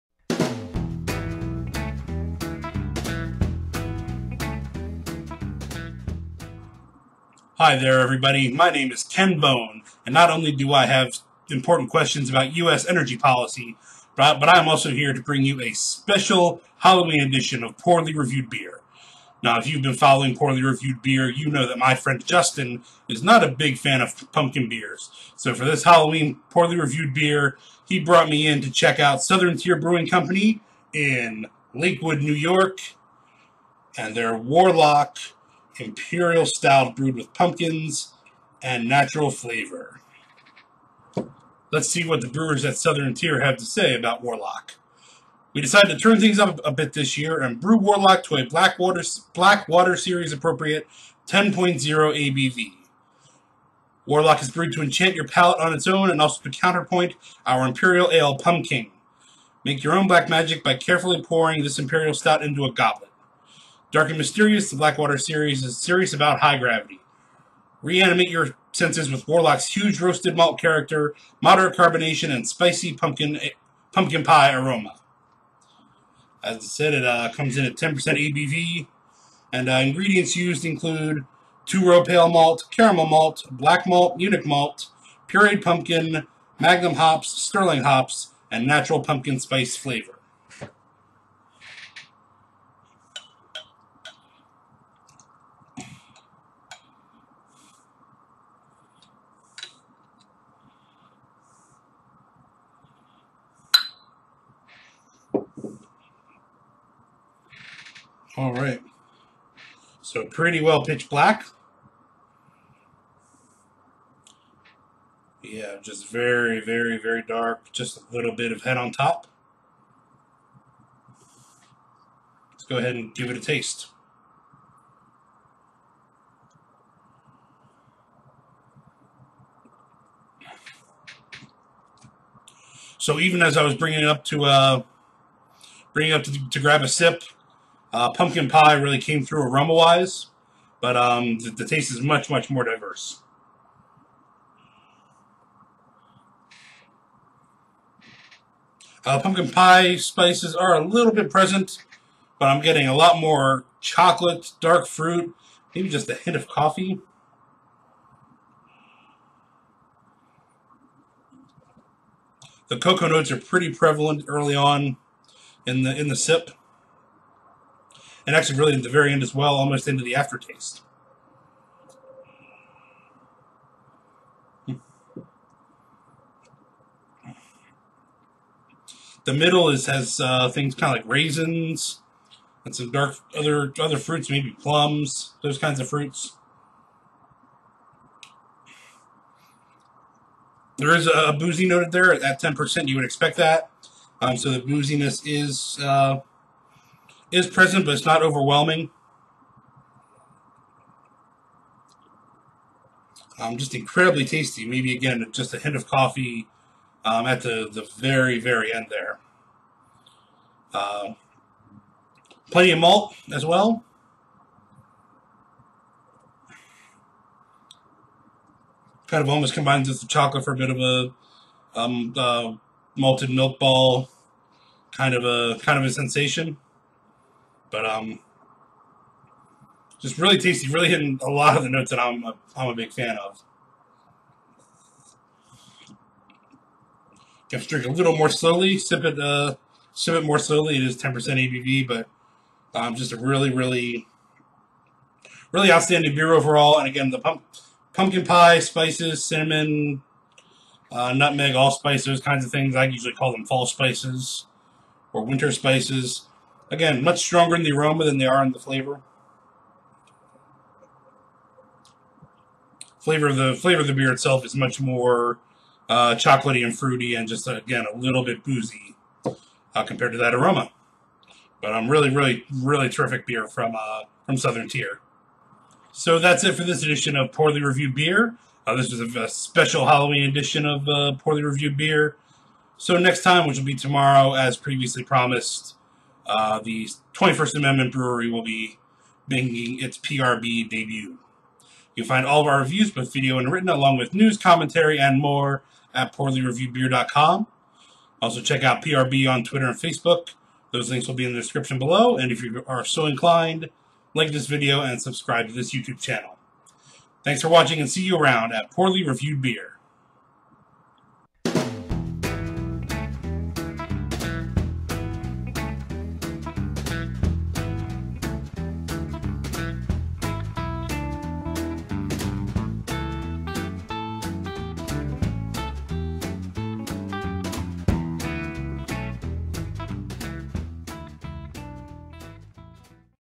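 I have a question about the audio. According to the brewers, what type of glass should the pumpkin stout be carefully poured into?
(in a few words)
goblet.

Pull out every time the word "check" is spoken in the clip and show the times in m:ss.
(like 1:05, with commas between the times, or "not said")
0:28, 4:58.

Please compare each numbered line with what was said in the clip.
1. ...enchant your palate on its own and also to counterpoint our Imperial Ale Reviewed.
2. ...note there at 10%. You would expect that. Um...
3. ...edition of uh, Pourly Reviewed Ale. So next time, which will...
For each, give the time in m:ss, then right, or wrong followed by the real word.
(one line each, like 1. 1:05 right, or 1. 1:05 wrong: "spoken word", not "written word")
1. 0:54 wrong: "Pumking", not "Reviewed"
2. 3:11 right
3. 4:40 wrong: "Beer", not "Ale".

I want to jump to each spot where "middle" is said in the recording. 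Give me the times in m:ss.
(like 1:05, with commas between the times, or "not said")
2:59.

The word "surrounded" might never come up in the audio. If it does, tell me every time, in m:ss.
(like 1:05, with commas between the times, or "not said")
not said.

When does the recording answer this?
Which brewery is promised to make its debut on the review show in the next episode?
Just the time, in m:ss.
4:47.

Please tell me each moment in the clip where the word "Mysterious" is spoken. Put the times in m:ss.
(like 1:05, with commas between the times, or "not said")
1:04.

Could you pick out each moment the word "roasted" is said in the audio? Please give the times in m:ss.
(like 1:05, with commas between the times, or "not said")
1:09.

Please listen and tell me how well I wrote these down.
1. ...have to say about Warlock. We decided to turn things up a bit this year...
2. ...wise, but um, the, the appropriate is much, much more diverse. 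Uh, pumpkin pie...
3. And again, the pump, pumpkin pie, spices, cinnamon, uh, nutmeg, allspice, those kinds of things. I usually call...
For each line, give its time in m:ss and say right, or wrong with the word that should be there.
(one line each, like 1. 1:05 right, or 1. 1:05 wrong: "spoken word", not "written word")
1. 0:43 right
2. 2:19 wrong: "taste", not "appropriate"
3. 4:06 right.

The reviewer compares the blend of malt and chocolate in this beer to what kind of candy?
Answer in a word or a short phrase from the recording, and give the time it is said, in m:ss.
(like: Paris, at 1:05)
malted milk ball, at 3:42.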